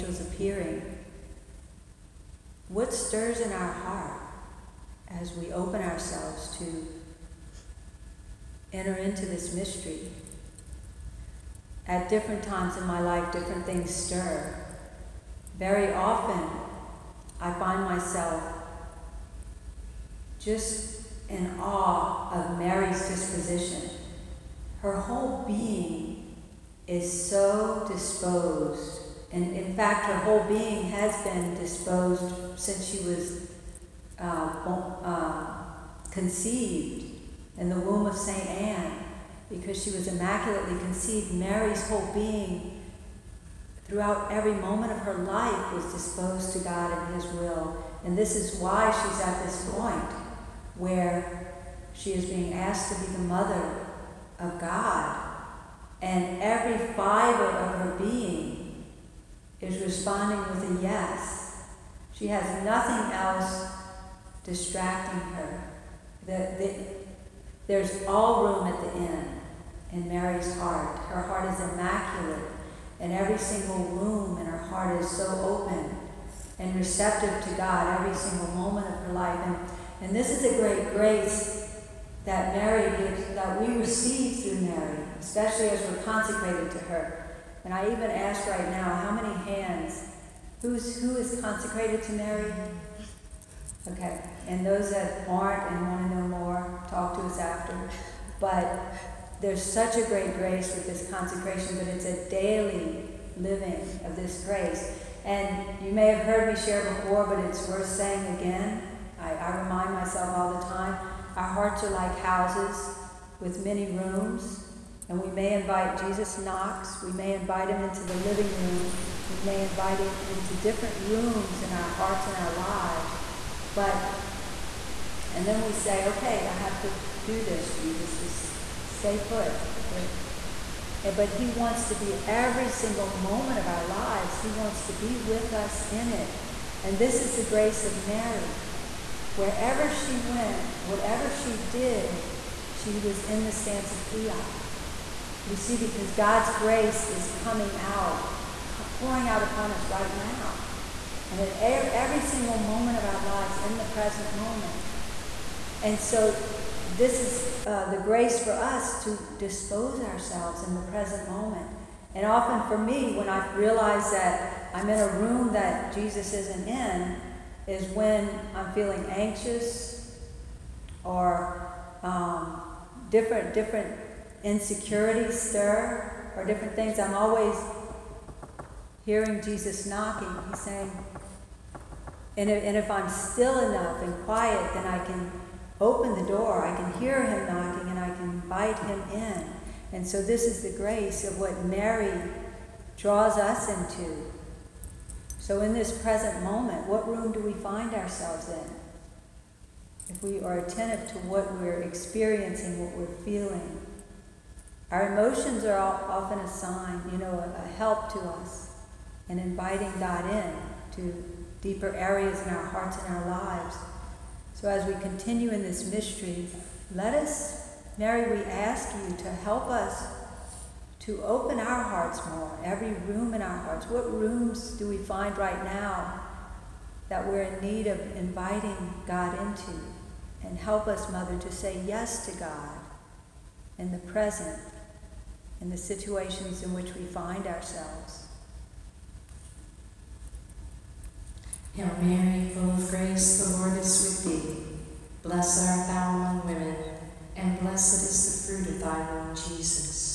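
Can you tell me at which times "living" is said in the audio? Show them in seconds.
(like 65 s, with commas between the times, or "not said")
103 s, 118 s.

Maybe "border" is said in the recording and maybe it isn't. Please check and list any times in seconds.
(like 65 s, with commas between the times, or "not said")
not said.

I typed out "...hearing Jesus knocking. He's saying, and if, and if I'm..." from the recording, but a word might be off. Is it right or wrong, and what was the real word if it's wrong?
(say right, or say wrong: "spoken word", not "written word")
right.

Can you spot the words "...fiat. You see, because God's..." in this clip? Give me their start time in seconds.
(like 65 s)
144 s.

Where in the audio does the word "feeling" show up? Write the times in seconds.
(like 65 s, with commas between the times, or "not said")
168 s, 203 s.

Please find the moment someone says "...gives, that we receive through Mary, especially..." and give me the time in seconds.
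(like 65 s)
82 s.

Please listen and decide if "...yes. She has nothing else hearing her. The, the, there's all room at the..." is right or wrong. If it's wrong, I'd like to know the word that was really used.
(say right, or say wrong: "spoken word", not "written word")
wrong: "distracting", not "hearing".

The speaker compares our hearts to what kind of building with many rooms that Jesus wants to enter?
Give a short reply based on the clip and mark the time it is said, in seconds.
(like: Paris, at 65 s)
Houses, at 112 s.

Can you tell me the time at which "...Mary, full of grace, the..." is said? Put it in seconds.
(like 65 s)
242 s.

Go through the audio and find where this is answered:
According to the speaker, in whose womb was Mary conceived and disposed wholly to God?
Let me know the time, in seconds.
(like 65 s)
38 s.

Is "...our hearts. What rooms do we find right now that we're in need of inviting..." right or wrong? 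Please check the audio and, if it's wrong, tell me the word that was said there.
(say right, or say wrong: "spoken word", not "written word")
right.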